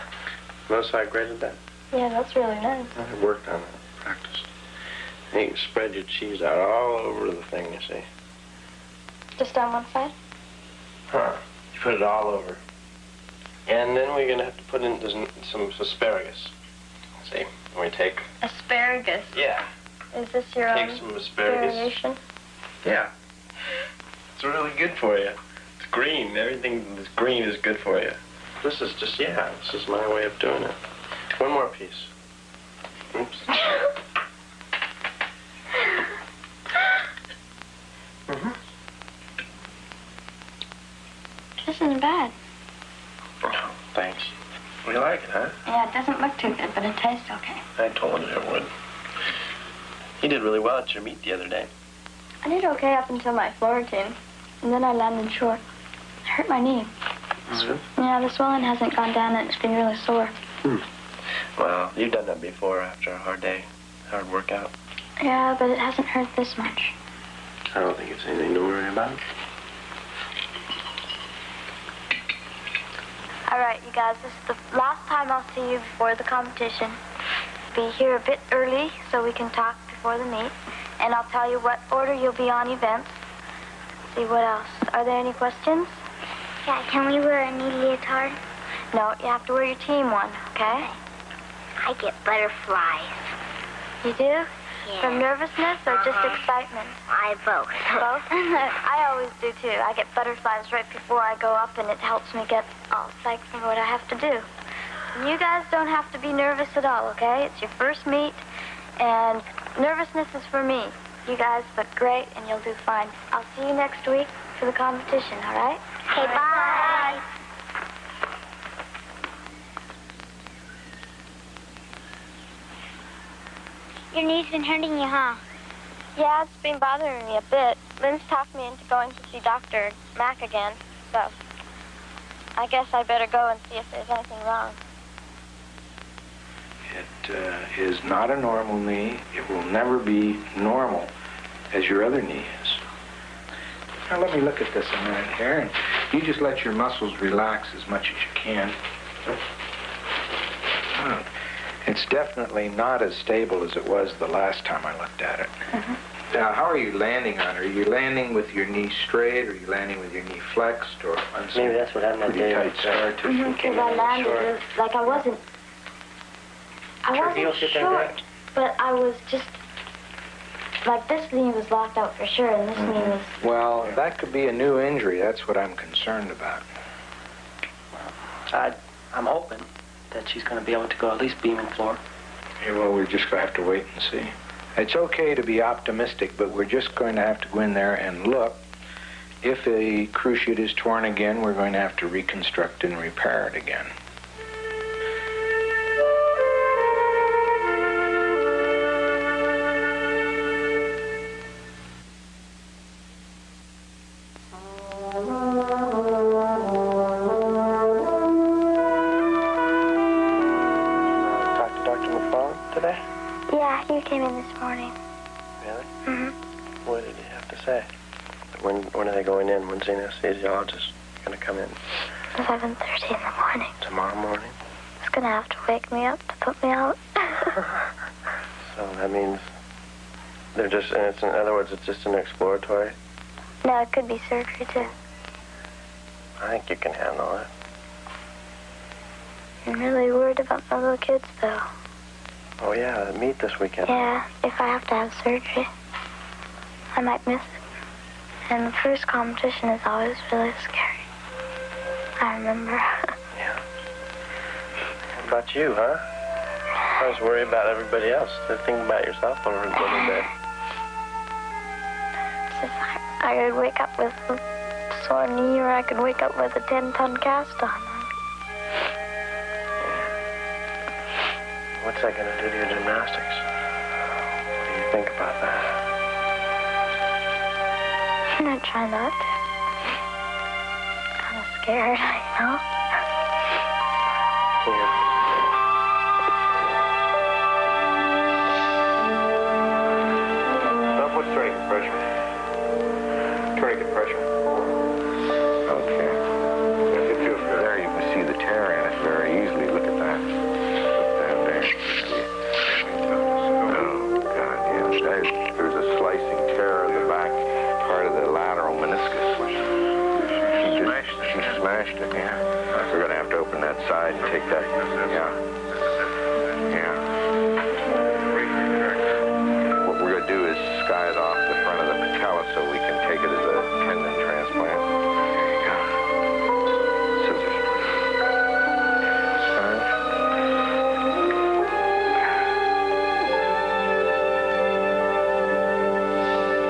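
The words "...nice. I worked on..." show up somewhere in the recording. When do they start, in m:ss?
0:02.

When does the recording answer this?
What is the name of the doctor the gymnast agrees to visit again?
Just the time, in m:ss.
2:09.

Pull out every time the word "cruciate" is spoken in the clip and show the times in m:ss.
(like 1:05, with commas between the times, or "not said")
3:10.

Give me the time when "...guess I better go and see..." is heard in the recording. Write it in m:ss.
2:12.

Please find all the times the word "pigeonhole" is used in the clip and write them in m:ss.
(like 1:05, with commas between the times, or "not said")
not said.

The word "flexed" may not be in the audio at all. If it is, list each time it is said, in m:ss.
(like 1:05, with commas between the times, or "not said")
2:40.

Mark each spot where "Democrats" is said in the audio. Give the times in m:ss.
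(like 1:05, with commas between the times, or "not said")
not said.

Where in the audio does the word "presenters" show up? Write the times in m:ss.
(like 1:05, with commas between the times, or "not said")
not said.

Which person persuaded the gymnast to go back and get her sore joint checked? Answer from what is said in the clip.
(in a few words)
Lynn.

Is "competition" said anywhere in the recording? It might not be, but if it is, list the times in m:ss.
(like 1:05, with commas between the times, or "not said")
1:16, 1:54, 4:09.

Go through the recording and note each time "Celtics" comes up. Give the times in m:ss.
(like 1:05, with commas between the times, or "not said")
not said.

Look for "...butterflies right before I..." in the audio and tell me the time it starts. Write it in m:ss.
1:40.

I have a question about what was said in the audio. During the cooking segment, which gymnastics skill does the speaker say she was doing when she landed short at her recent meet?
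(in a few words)
Florentine.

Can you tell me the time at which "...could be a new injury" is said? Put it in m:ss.
2:54.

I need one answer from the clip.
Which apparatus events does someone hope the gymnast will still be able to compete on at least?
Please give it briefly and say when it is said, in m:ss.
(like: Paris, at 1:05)
Beam and floor, at 3:01.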